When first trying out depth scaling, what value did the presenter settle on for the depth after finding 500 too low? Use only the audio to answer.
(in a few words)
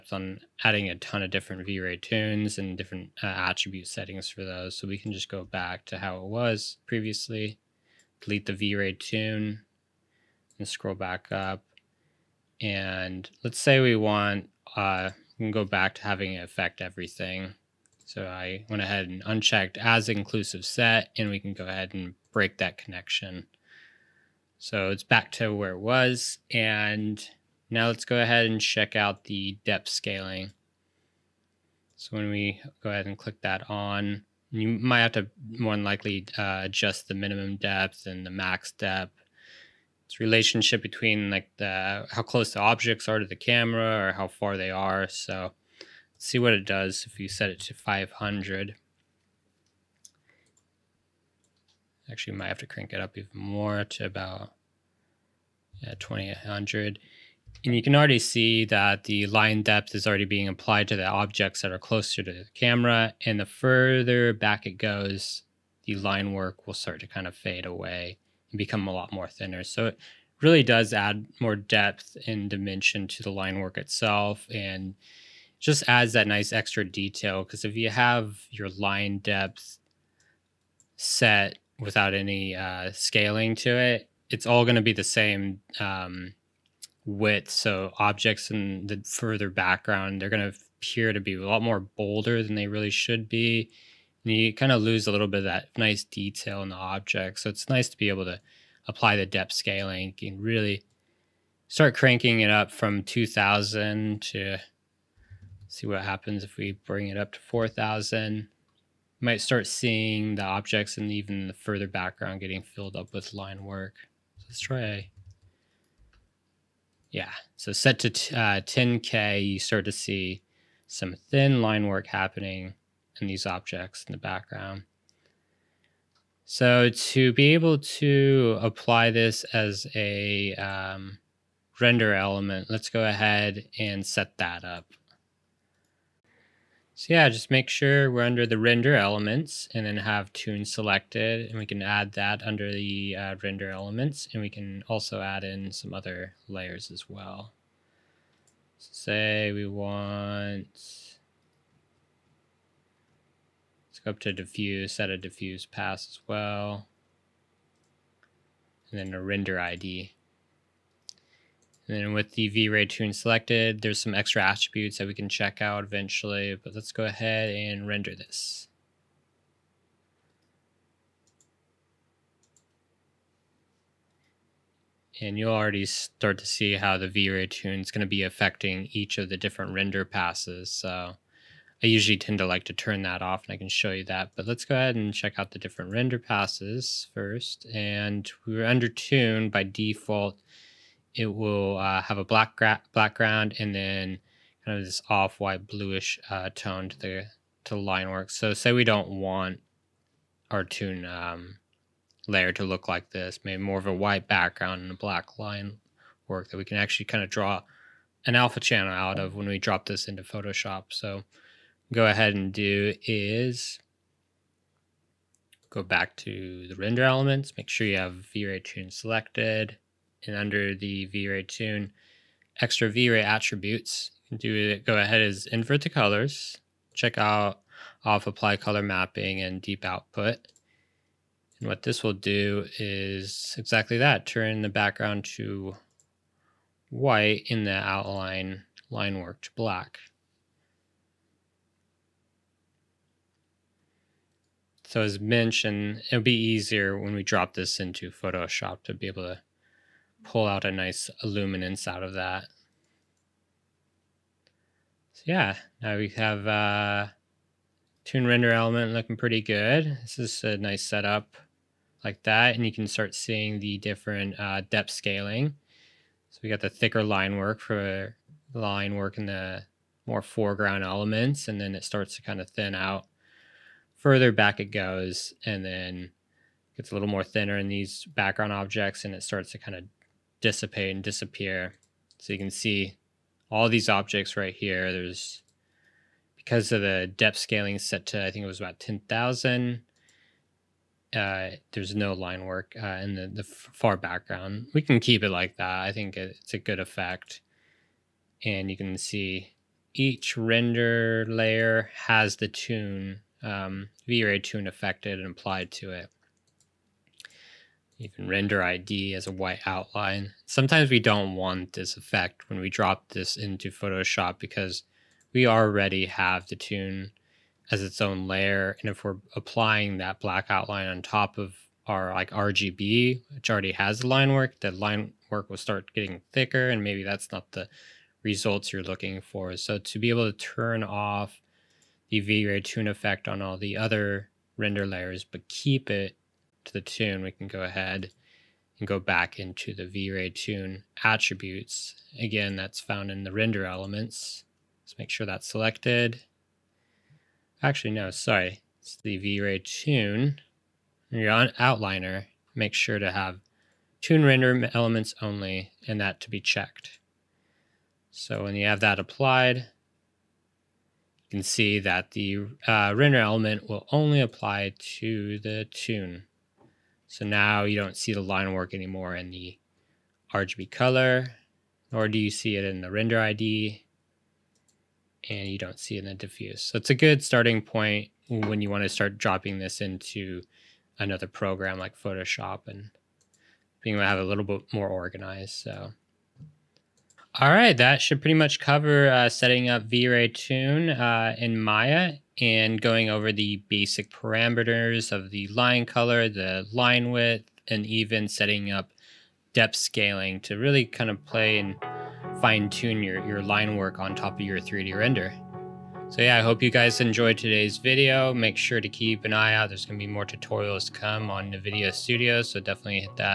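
2800.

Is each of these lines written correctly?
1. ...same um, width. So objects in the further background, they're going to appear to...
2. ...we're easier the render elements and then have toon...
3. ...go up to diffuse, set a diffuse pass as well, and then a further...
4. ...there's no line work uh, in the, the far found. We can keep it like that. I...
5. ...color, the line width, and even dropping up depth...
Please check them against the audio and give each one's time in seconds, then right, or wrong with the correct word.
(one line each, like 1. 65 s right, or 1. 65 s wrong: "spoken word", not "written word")
1. 85 s right
2. 138 s wrong: "under", not "easier"
3. 154 s wrong: "render", not "further"
4. 291 s wrong: "background", not "found"
5. 395 s wrong: "setting", not "dropping".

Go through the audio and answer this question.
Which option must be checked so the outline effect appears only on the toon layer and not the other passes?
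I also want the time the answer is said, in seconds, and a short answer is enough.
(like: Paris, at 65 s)
toon render elements only, at 354 s.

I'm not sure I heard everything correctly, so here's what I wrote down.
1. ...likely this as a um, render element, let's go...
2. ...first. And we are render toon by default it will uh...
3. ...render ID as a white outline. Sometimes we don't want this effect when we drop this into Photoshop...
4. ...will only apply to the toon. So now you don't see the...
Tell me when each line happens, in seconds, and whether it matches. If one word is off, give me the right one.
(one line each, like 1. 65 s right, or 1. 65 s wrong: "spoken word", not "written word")
1. 128 s wrong: "apply", not "likely"
2. 187 s wrong: "under", not "render"
3. 308 s right
4. 363 s right.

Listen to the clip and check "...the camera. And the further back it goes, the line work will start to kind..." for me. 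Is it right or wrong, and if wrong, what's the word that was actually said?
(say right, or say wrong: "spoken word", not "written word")
right.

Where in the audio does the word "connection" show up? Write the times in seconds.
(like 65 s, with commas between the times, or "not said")
22 s.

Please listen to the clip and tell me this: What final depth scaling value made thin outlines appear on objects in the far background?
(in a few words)
10K.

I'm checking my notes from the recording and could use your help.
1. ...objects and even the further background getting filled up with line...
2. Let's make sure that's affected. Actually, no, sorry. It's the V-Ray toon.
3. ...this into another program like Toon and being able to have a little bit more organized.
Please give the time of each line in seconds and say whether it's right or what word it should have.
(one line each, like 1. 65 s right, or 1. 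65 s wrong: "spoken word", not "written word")
1. 110 s right
2. 344 s wrong: "selected", not "affected"
3. 379 s wrong: "Photoshop", not "Toon".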